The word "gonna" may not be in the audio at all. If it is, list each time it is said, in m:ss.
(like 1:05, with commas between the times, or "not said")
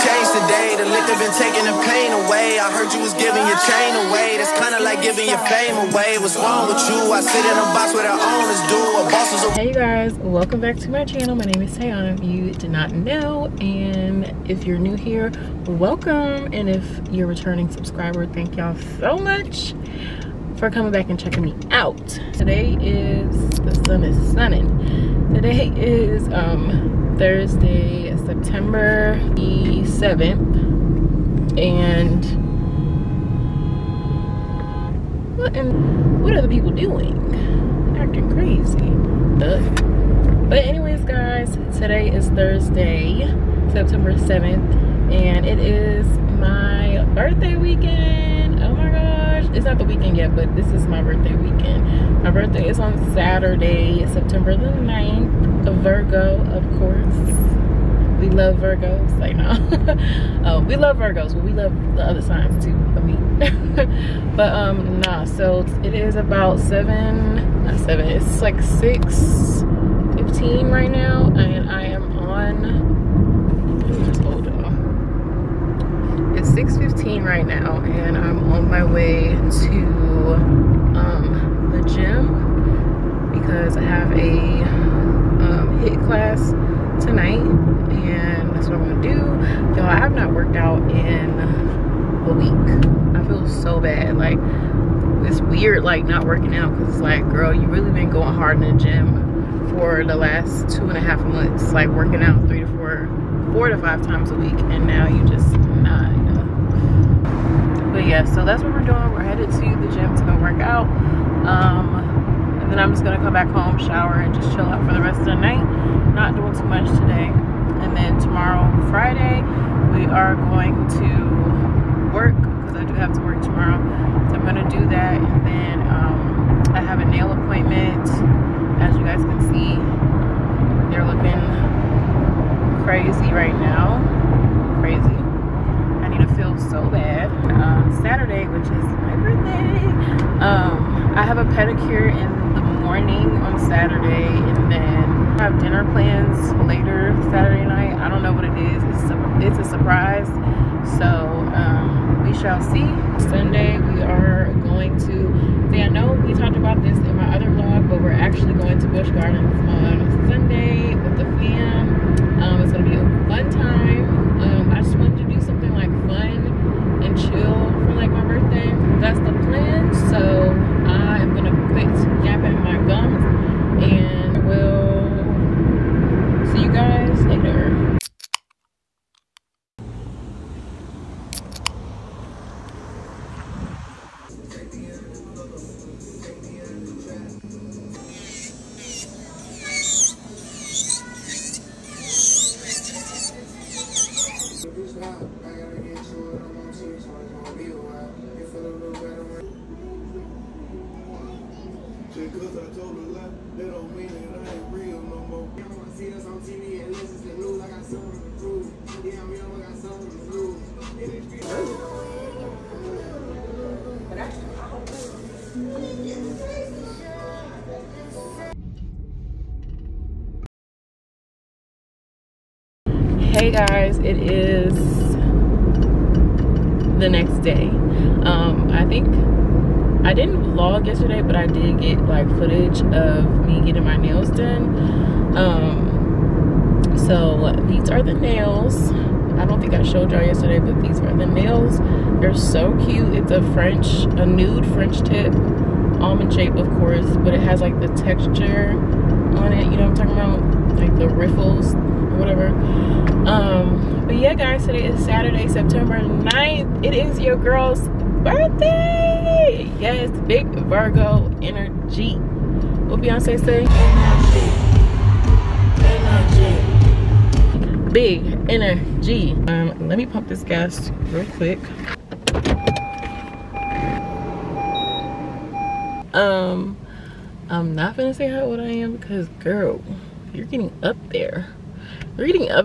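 1:29, 4:37.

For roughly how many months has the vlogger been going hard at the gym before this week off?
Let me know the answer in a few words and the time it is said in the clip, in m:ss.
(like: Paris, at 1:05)
2 and a half months, at 1:40.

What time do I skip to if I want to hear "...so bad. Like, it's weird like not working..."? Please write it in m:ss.
1:33.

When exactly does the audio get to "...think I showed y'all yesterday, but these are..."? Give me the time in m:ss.
3:59.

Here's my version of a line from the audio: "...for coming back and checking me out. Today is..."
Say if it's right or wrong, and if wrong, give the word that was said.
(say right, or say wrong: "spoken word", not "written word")
right.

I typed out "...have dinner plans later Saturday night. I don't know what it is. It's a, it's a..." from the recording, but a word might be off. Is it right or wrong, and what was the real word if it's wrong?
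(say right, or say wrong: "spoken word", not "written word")
right.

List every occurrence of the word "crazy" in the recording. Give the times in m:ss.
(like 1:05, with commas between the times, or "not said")
0:38, 2:12.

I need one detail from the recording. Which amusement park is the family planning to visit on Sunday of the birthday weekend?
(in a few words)
Busch Gardens.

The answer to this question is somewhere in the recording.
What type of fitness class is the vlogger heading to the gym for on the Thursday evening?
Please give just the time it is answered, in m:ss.
1:25.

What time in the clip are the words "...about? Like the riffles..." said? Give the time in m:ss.
4:10.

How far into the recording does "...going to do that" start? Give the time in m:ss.
2:04.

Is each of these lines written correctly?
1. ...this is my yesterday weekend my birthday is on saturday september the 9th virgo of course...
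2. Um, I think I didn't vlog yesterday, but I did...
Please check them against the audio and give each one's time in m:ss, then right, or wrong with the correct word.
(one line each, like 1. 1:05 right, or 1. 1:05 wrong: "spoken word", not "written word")
1. 0:50 wrong: "birthday", not "yesterday"
2. 3:48 right.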